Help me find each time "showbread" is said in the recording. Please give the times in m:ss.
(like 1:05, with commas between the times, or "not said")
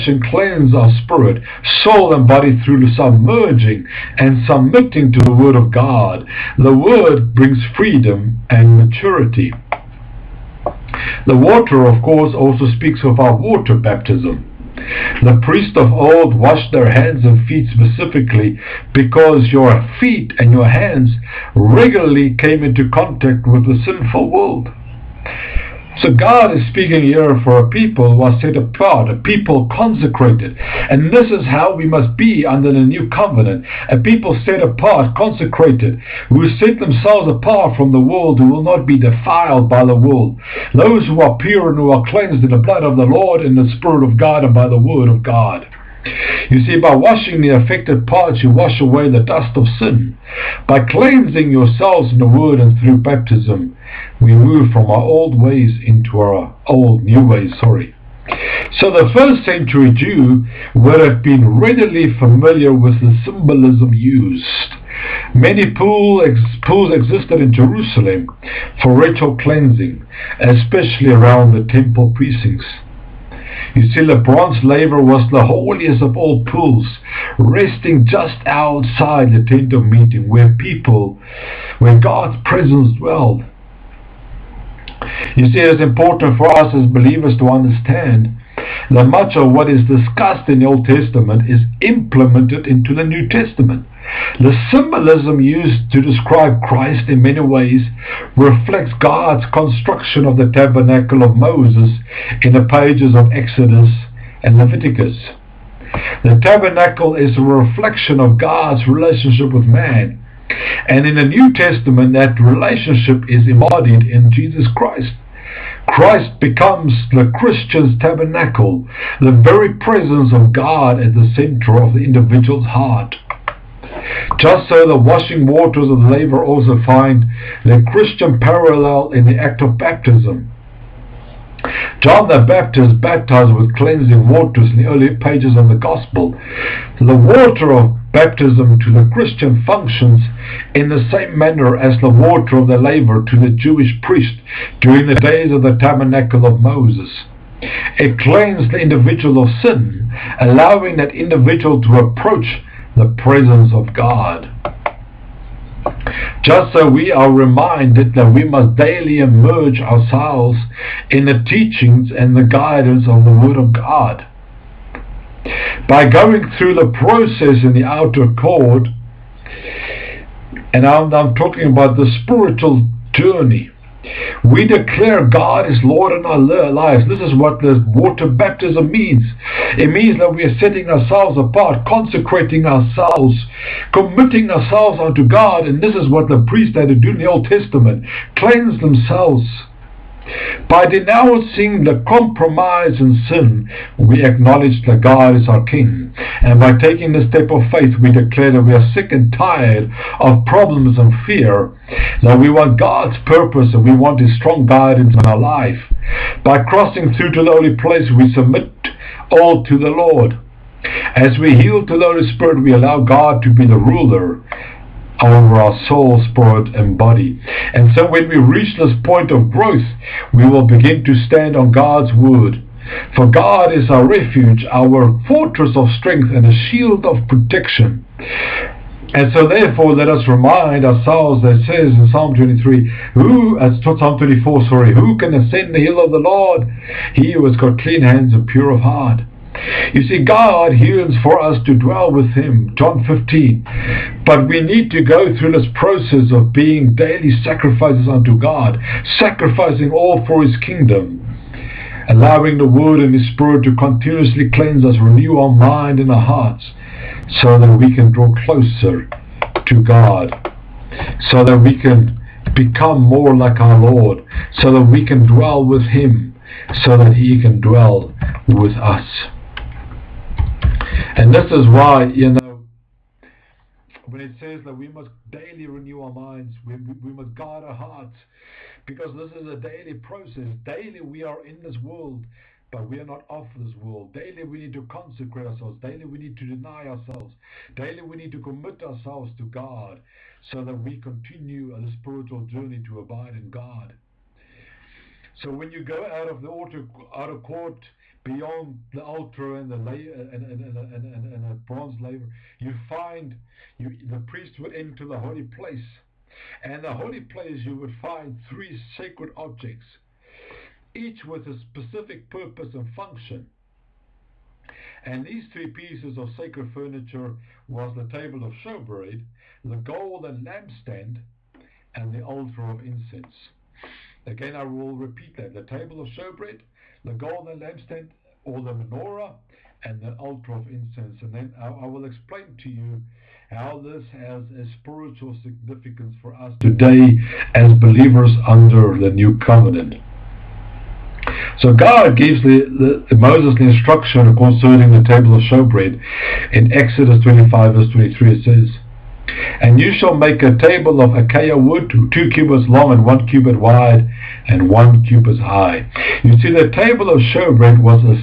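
5:18, 5:26, 5:45, 5:57.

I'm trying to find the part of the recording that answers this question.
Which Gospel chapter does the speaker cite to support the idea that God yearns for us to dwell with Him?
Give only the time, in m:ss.
4:02.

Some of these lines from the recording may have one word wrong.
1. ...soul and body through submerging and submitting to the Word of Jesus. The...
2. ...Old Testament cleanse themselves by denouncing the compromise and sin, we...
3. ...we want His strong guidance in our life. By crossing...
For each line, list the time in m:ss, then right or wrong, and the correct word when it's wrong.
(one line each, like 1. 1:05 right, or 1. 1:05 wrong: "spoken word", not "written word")
1. 0:01 wrong: "God", not "Jesus"
2. 3:07 right
3. 3:23 right.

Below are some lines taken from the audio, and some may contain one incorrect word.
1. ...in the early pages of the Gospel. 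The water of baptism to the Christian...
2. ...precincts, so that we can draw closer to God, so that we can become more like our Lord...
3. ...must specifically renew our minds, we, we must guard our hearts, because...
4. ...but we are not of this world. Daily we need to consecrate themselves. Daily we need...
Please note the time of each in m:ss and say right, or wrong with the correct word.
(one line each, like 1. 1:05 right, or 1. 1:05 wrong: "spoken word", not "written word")
1. 2:14 right
2. 4:16 wrong: "hearts", not "precincts"
3. 4:34 wrong: "daily", not "specifically"
4. 4:42 wrong: "ourselves", not "themselves".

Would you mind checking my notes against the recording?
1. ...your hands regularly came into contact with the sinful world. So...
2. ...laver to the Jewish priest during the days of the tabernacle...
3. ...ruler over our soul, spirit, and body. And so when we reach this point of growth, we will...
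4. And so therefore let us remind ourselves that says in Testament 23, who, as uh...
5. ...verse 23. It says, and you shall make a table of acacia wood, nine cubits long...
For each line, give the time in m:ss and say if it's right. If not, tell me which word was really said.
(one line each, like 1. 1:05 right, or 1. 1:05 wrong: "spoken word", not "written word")
1. 0:20 right
2. 2:22 right
3. 3:33 right
4. 3:49 wrong: "Psalm", not "Testament"
5. 5:47 wrong: "two", not "nine".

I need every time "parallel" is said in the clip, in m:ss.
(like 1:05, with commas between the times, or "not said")
2:08.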